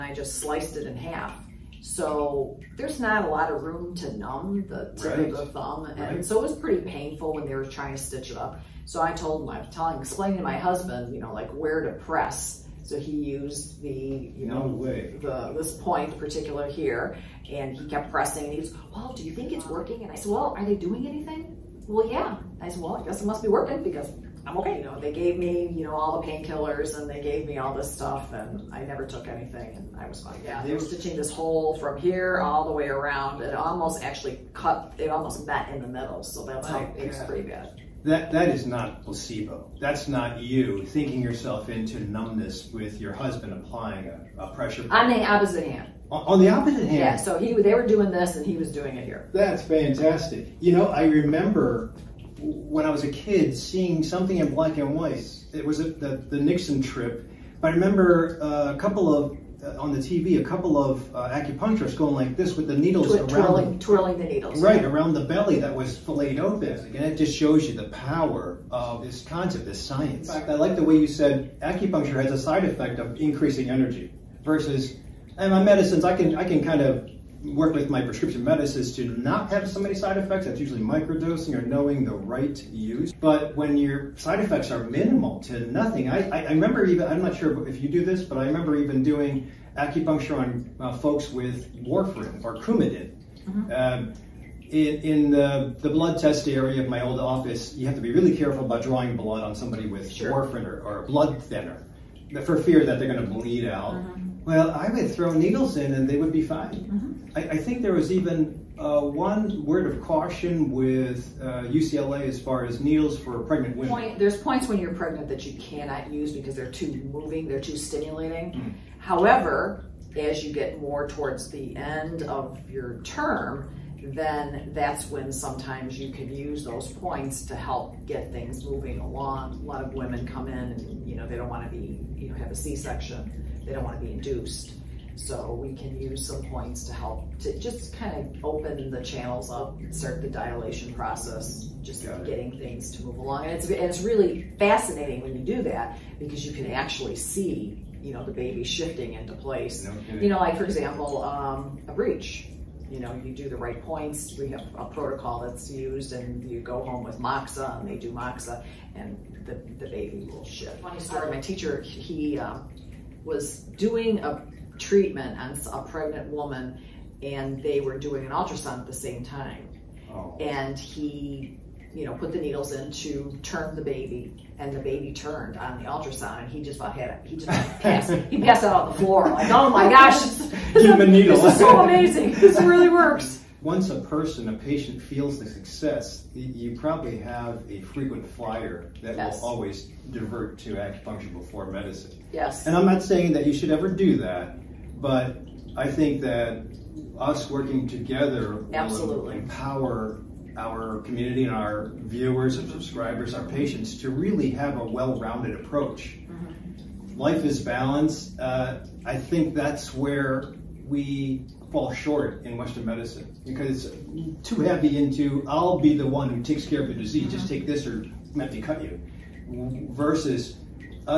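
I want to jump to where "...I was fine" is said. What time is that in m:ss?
0:29.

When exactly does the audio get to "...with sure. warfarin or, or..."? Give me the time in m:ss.
1:39.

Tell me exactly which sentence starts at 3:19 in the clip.
will empower our community and our viewers and subscribers, our patients, to really have a well-rounded approach.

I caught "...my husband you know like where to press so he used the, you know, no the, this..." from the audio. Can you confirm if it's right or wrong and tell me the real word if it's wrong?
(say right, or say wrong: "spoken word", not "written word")
right.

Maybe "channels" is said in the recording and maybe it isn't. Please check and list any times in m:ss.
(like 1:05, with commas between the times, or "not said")
2:19.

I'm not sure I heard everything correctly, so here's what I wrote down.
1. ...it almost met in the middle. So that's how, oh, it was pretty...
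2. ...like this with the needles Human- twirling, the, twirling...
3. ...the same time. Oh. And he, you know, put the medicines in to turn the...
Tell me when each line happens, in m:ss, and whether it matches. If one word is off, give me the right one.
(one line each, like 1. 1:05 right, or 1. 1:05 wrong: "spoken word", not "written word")
1. 0:34 right
2. 1:02 wrong: "Twi", not "Human"
3. 2:48 wrong: "needles", not "medicines".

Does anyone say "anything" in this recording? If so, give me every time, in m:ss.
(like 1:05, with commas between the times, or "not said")
0:21, 0:29.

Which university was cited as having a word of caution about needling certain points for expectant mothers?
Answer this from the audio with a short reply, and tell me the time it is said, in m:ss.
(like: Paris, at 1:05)
UCLA, at 1:51.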